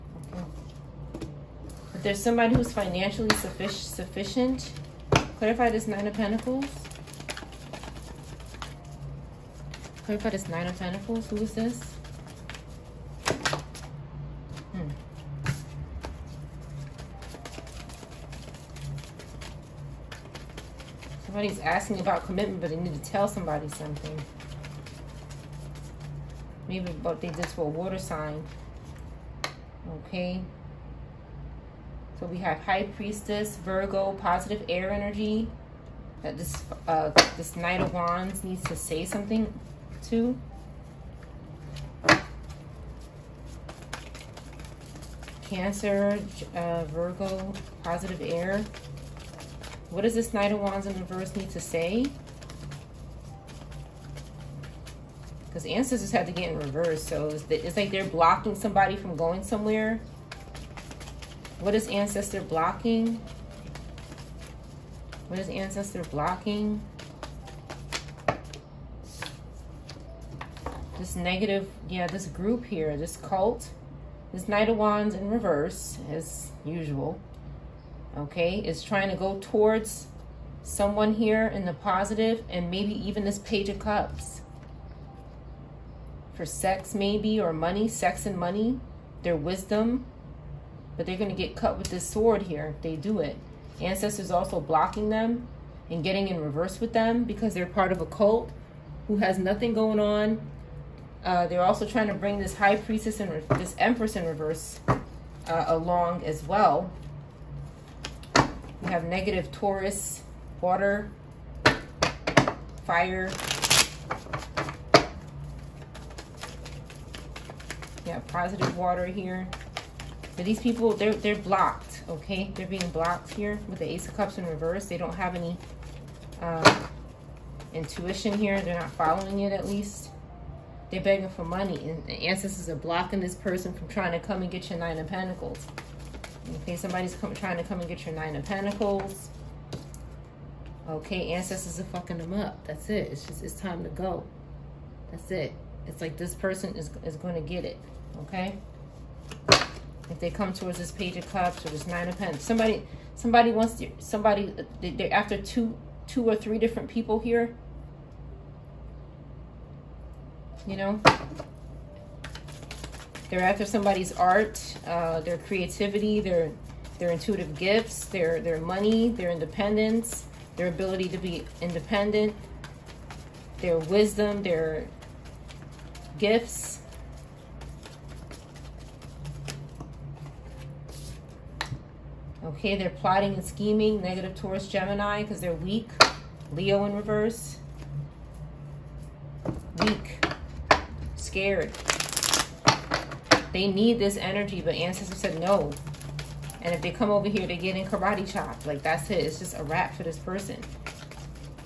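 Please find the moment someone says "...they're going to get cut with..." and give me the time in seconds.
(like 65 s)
91 s.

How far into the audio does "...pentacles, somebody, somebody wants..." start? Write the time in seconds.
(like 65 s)
152 s.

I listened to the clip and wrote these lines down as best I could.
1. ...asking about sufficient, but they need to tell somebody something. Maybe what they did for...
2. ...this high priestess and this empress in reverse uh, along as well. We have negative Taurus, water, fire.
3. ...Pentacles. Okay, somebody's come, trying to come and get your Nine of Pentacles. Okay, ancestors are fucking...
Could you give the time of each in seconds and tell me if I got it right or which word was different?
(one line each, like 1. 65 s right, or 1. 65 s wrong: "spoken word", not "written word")
1. 21 s wrong: "commitment", not "sufficient"
2. 102 s right
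3. 135 s right.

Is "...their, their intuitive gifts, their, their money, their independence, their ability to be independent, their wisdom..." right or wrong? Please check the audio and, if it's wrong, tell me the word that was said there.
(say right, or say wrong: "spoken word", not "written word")
right.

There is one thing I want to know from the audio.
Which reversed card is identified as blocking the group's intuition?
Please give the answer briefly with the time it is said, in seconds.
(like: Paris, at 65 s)
Ace of Cups, at 123 s.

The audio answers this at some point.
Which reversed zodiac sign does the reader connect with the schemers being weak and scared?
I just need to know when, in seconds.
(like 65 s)
186 s.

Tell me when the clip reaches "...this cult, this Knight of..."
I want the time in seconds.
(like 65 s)
72 s.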